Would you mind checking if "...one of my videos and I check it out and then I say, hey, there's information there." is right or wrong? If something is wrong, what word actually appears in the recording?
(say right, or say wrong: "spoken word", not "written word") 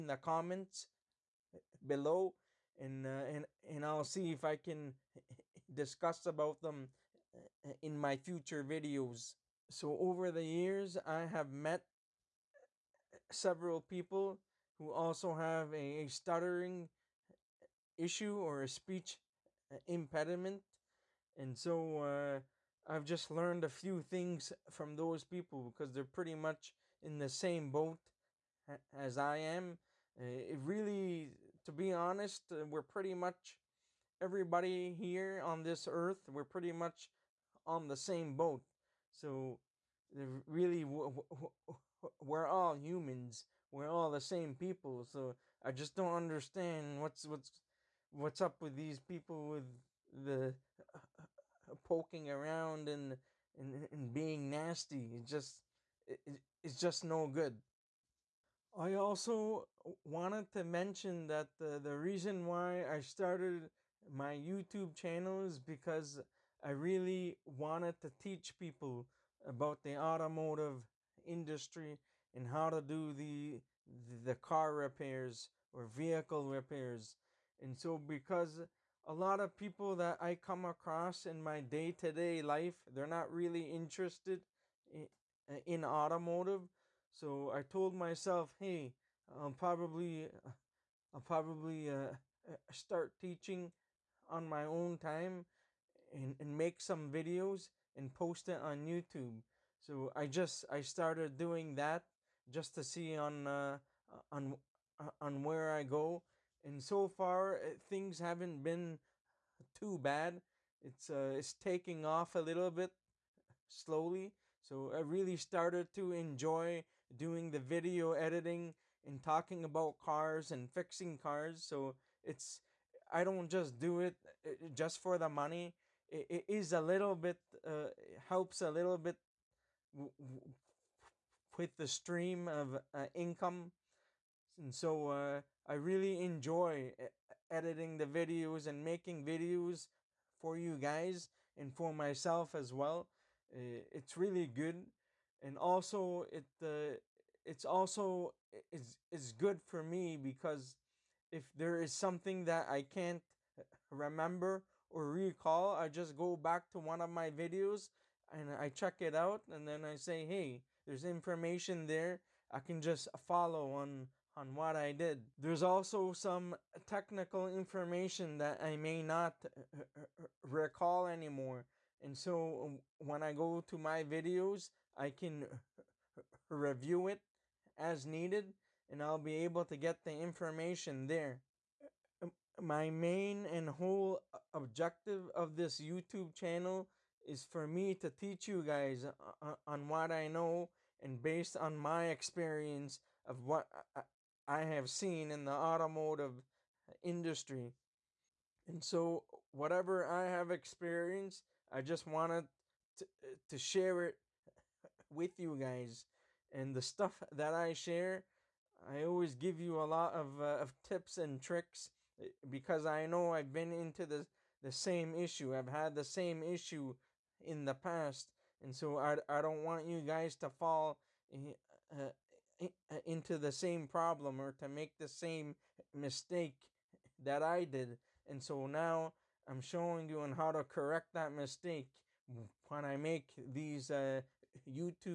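right.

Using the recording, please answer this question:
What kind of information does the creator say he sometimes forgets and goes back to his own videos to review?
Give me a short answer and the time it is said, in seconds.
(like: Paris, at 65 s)
technical information, at 166 s.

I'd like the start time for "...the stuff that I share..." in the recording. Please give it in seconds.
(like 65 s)
206 s.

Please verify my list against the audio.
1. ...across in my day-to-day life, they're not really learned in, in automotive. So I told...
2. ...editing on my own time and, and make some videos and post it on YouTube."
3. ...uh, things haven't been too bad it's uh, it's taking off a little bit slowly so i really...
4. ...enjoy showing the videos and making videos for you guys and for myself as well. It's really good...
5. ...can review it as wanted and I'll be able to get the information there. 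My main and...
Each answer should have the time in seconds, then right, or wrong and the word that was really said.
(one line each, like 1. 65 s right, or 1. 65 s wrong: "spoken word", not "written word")
1. 80 s wrong: "interested", not "learned"
2. 93 s wrong: "teaching", not "editing"
3. 107 s right
4. 136 s wrong: "editing", not "showing"
5. 175 s wrong: "needed", not "wanted".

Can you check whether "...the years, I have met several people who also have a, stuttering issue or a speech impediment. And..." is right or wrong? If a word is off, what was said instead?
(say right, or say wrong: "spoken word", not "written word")
right.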